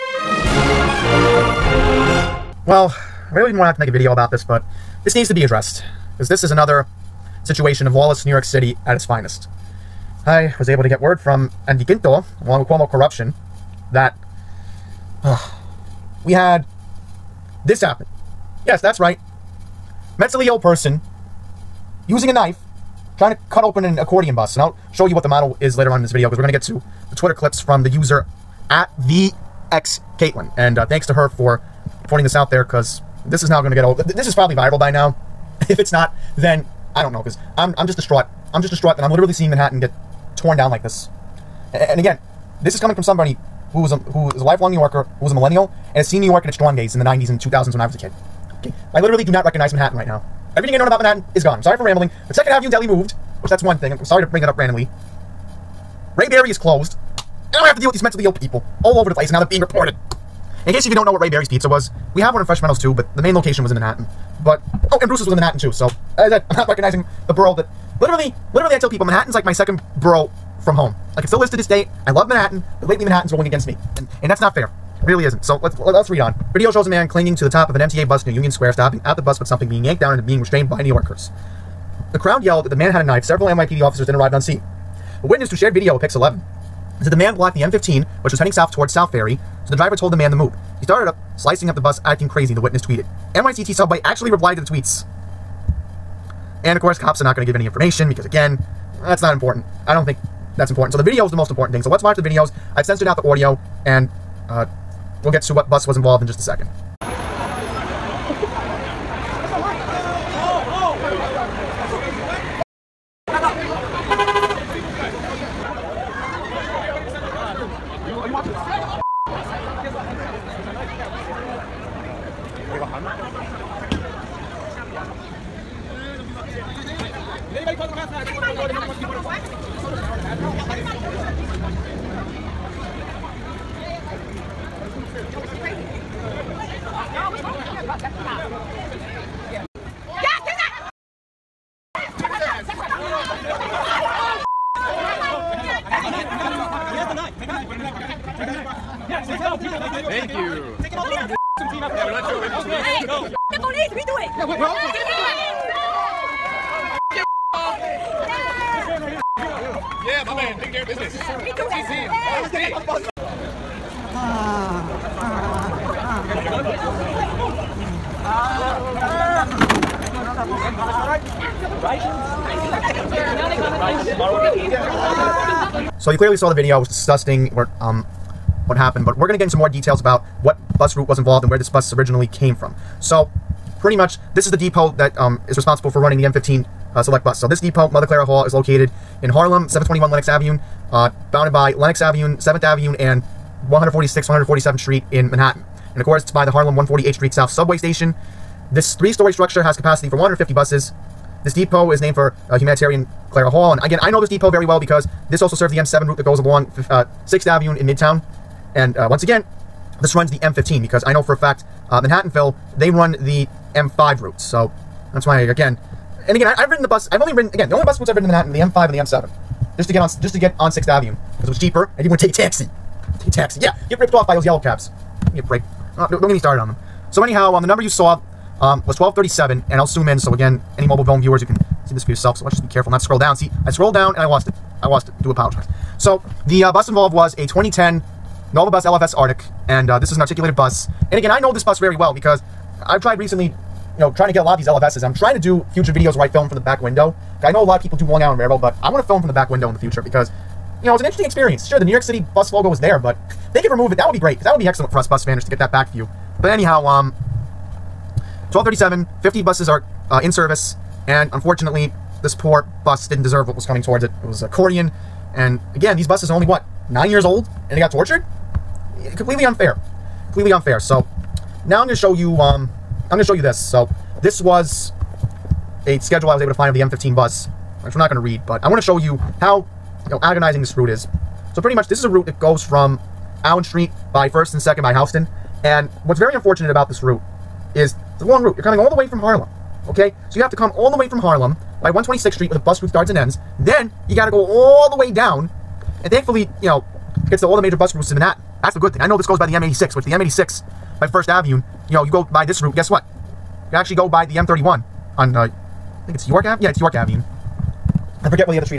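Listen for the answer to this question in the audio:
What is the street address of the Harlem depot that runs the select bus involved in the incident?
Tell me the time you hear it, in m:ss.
3:09.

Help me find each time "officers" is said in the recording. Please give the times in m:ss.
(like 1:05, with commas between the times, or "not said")
1:23.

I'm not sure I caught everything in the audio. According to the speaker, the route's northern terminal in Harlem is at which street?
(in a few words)
126th Street.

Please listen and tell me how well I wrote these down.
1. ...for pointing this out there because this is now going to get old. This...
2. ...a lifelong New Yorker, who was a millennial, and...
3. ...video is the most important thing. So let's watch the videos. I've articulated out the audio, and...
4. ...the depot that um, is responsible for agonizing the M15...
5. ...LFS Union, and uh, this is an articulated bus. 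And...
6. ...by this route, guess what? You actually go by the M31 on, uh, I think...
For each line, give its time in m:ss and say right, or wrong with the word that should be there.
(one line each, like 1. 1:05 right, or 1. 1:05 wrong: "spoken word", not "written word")
1. 0:31 right
2. 0:44 right
3. 1:41 wrong: "censored", not "articulated"
4. 3:04 wrong: "running", not "agonizing"
5. 3:58 wrong: "Artic", not "Union"
6. 5:02 right.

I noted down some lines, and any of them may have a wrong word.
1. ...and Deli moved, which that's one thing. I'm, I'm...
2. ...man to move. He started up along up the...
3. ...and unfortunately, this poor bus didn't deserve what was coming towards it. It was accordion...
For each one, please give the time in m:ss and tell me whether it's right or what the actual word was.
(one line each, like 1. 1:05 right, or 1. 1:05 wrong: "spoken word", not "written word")
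1. 0:52 right
2. 1:30 wrong: "slicing", not "along"
3. 4:21 right.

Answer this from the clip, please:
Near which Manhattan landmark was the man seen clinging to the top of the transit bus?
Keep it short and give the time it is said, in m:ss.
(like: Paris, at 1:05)
Union Square, at 1:18.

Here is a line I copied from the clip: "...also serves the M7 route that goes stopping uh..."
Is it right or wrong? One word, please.
wrong.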